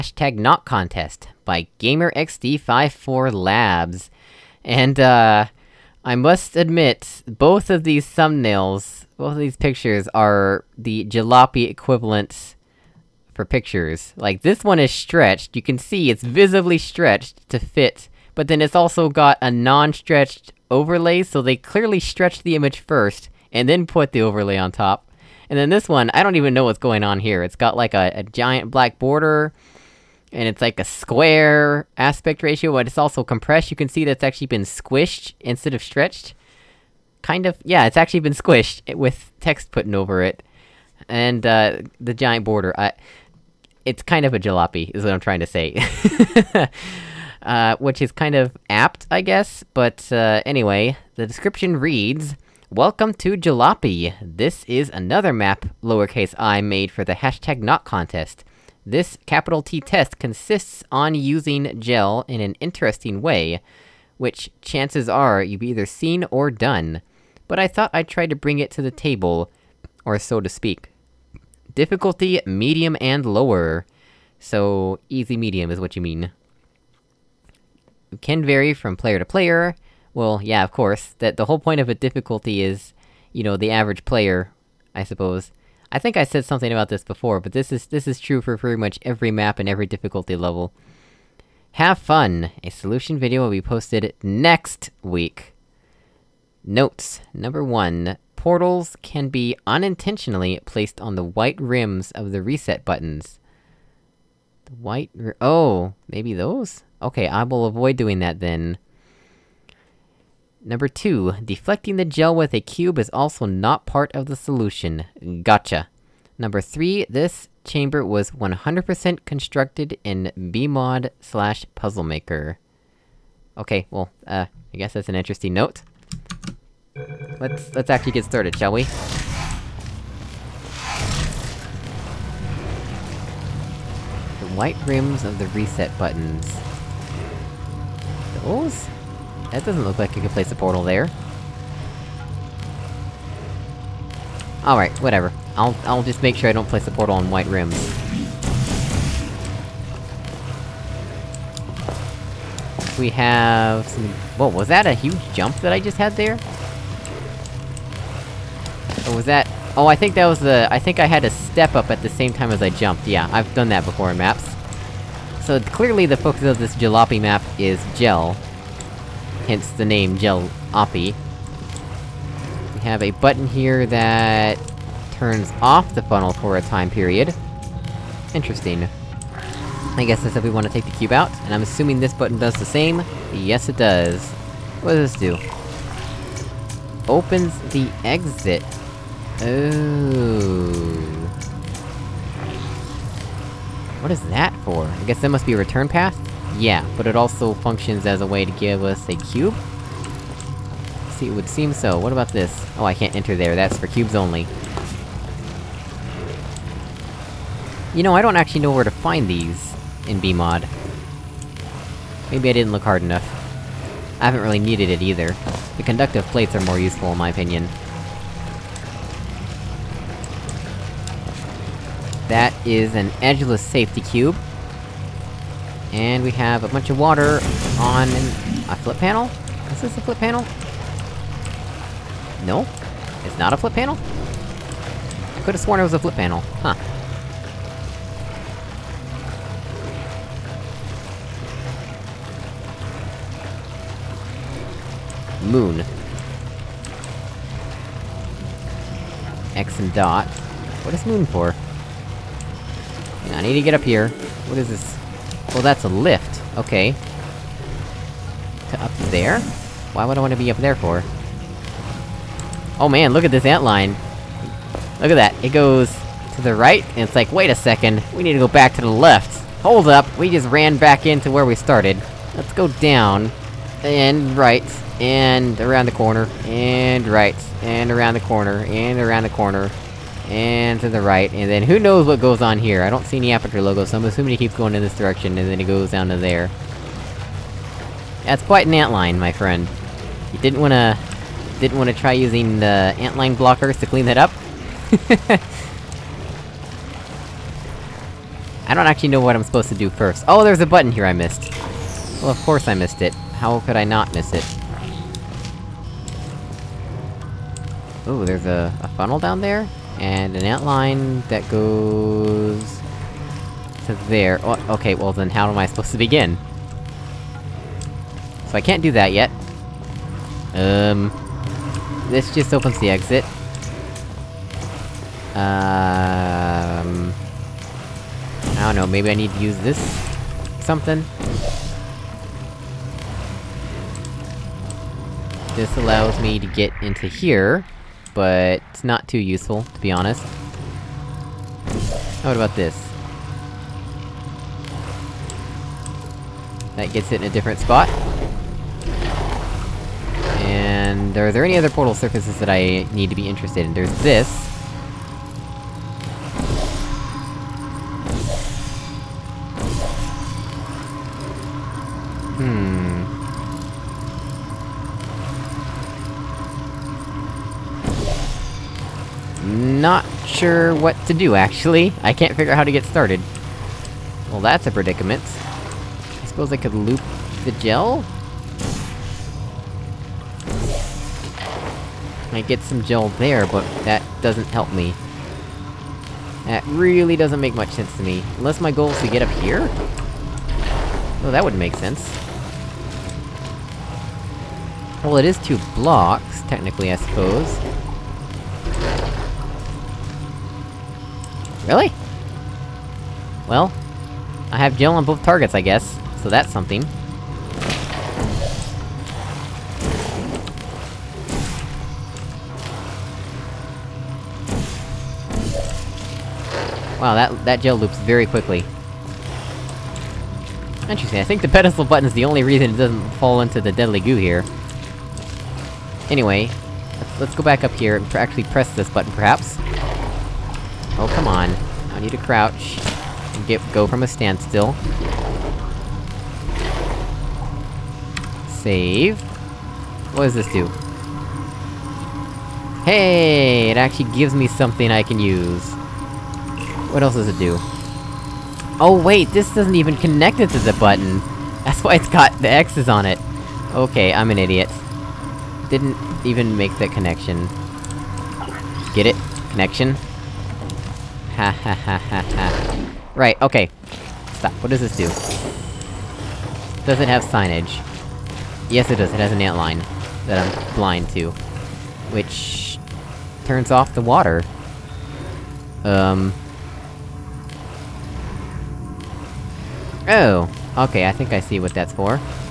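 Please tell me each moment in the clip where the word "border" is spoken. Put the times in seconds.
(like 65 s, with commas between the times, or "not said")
28 s, 42 s.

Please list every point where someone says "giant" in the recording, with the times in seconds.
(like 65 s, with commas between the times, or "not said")
28 s, 42 s.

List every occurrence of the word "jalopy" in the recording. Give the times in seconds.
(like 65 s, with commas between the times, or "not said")
11 s, 44 s.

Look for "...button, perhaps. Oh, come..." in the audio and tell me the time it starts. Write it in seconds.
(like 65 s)
428 s.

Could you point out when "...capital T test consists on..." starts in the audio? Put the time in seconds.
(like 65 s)
59 s.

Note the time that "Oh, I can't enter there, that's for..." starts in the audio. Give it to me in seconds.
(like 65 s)
202 s.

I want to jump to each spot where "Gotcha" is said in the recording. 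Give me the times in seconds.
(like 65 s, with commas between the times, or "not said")
115 s.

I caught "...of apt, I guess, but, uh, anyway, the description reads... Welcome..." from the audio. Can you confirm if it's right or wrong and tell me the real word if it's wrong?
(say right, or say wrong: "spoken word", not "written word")
right.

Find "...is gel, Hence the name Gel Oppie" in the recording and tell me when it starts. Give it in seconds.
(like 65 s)
167 s.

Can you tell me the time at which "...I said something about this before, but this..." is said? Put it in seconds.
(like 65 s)
86 s.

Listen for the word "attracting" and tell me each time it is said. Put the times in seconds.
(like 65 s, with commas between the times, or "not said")
not said.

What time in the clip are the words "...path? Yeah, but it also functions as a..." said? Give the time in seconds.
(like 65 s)
195 s.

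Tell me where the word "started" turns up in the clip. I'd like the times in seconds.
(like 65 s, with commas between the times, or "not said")
128 s, 271 s, 372 s.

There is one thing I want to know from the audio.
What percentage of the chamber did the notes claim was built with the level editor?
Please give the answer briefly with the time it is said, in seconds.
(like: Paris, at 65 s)
100%, at 118 s.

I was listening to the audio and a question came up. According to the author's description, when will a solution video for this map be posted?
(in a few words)
next week.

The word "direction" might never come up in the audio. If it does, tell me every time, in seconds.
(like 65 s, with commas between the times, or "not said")
284 s.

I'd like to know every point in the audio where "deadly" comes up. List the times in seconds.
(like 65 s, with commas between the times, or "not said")
423 s.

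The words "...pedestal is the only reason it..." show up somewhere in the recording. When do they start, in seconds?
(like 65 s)
421 s.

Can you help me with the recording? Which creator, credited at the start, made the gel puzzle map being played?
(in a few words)
GamerXD54Labs.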